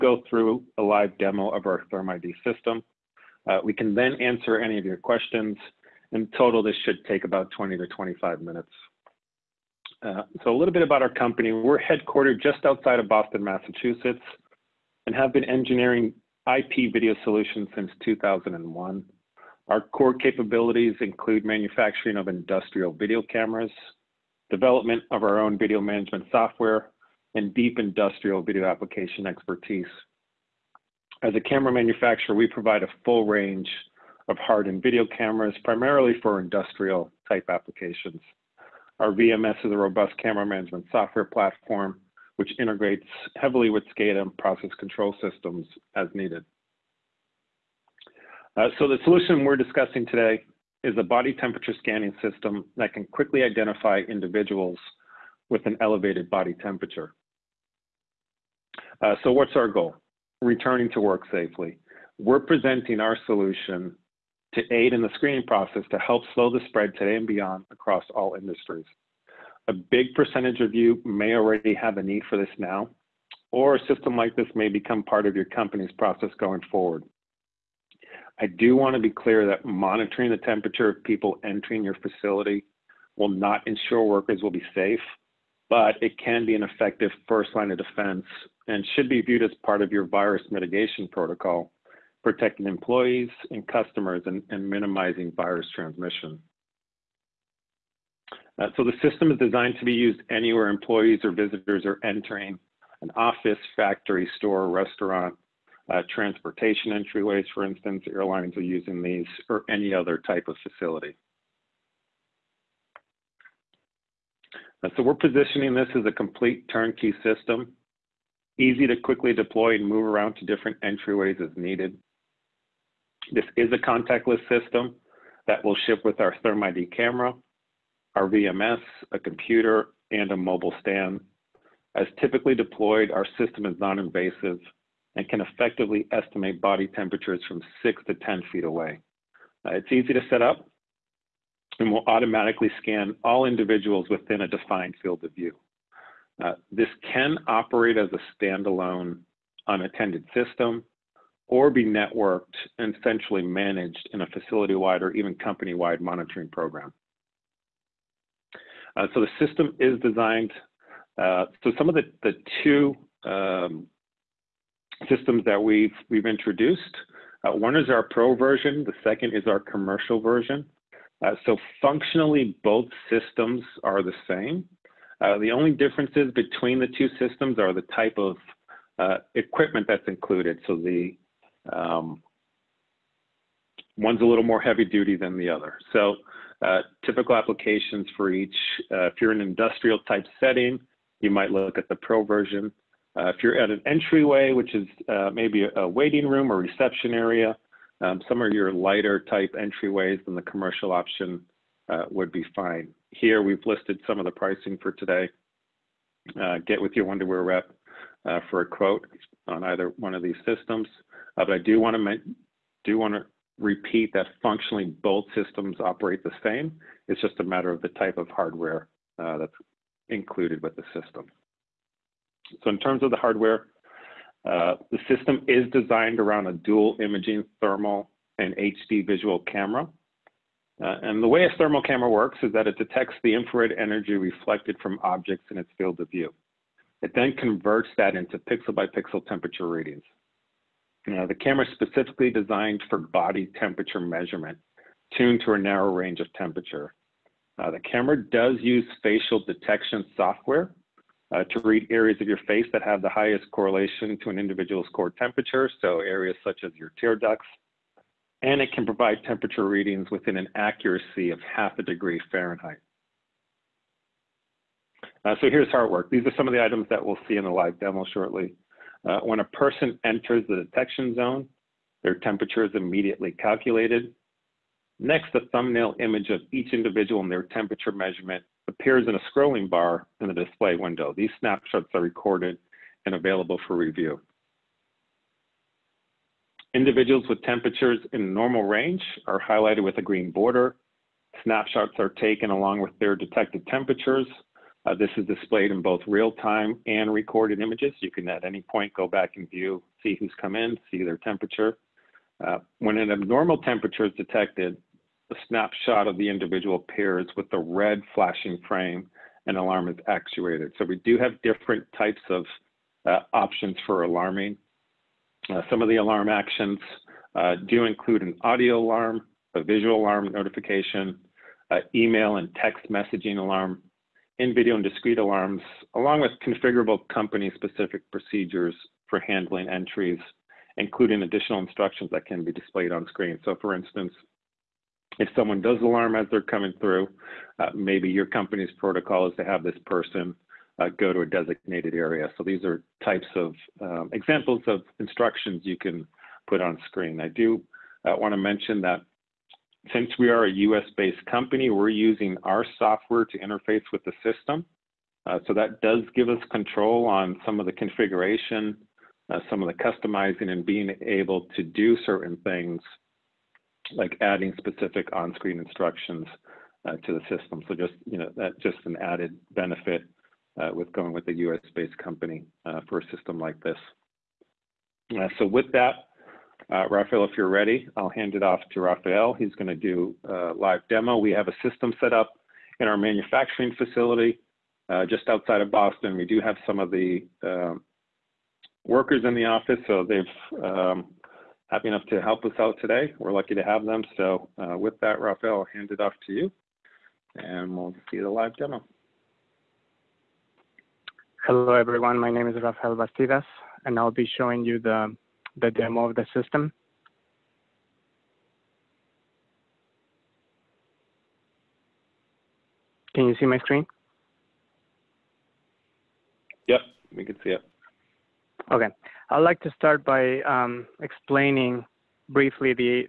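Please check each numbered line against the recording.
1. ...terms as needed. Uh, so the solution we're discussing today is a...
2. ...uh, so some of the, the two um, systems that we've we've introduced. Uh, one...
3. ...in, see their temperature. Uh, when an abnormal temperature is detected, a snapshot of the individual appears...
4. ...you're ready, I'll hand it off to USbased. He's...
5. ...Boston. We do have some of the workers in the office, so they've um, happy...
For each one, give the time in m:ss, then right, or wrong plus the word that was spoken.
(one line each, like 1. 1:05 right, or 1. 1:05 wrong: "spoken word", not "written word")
1. 0:45 wrong: "systems", not "terms"
2. 2:41 right
3. 5:00 right
4. 6:17 wrong: "Rafael", not "USbased"
5. 6:25 right.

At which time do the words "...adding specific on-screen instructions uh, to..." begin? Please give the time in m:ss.
6:04.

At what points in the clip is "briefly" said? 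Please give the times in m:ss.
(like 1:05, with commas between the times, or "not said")
7:02.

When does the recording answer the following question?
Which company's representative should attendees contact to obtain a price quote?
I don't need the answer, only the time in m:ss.
3:27.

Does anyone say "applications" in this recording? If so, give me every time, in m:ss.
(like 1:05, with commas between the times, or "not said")
0:28, 0:37, 3:07.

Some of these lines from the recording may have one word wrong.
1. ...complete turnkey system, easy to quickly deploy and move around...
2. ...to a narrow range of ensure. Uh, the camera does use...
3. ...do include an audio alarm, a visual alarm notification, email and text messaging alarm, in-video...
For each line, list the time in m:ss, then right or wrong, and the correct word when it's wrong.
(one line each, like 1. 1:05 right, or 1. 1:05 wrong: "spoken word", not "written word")
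1. 1:56 right
2. 4:05 wrong: "temperature", not "ensure"
3. 5:17 right.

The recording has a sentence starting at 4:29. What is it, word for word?
Uh, when a person enters the detection zone, their temperature is immediately calculated.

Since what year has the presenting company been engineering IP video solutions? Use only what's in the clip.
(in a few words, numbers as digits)
2001.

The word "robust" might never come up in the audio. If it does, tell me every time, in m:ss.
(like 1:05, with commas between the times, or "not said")
0:39.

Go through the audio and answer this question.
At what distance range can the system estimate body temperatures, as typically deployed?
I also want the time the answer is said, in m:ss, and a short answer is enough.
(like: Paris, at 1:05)
6 to 10 feet, at 2:17.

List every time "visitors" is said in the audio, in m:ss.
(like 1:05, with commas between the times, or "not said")
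1:41.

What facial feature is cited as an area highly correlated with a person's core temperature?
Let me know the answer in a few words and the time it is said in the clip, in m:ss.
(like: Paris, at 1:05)
Tear ducts, at 4:17.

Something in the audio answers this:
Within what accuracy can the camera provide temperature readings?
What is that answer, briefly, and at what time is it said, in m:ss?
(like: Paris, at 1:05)
Half a degree Fahrenheit, at 4:21.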